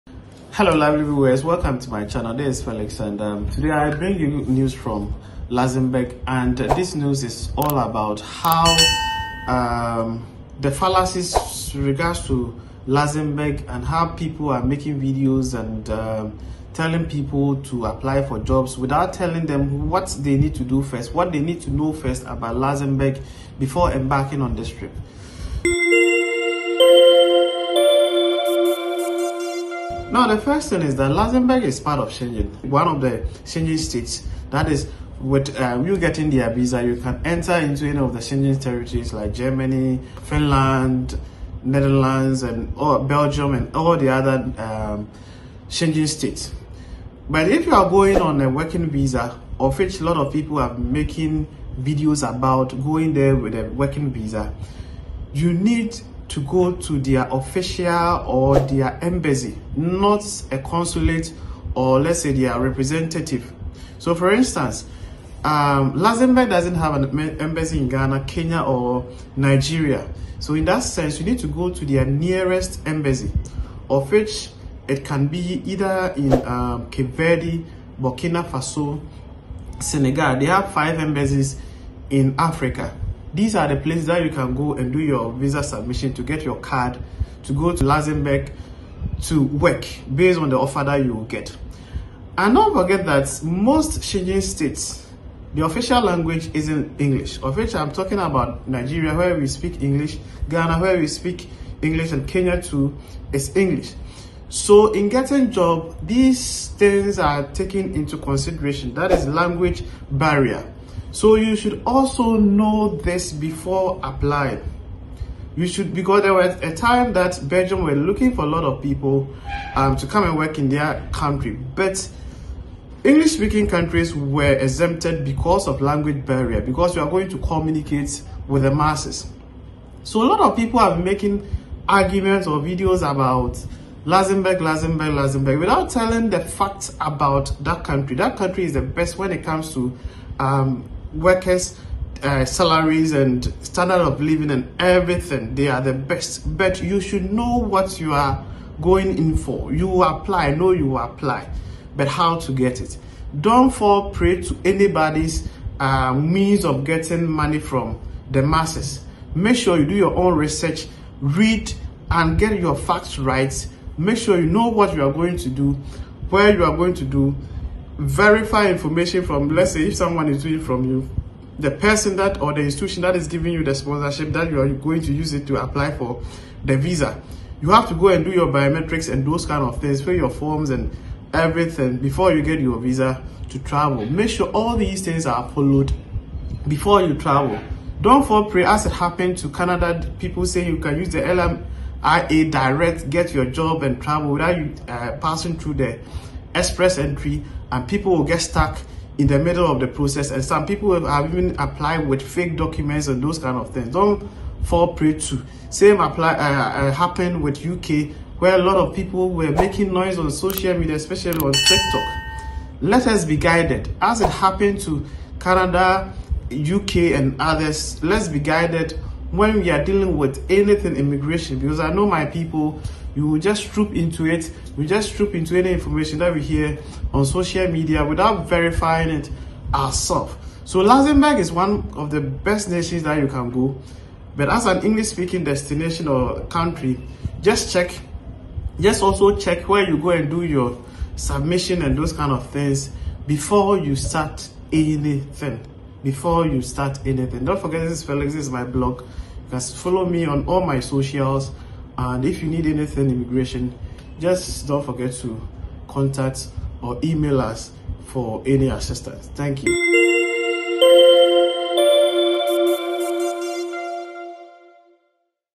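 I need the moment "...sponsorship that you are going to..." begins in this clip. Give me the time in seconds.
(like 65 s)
173 s.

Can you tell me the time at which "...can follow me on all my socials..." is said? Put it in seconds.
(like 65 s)
249 s.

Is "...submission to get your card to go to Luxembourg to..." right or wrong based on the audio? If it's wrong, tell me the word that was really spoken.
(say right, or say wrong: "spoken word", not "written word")
right.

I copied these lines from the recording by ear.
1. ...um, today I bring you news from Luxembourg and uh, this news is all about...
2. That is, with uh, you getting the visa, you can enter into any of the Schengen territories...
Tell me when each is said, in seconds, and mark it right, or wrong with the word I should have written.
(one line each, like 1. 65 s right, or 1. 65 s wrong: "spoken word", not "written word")
1. 3 s right
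2. 34 s right.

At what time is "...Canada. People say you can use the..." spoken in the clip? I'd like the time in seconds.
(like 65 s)
189 s.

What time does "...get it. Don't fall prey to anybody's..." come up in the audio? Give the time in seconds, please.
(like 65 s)
152 s.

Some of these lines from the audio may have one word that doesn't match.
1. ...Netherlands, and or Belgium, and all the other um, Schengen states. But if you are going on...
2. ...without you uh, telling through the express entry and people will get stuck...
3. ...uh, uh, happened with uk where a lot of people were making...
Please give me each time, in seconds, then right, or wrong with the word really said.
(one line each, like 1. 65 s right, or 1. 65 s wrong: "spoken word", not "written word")
1. 41 s right
2. 194 s wrong: "passing", not "telling"
3. 206 s right.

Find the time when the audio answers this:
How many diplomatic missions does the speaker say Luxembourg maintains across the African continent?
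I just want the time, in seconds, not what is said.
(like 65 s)
80 s.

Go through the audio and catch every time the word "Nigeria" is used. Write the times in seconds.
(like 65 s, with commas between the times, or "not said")
69 s, 98 s.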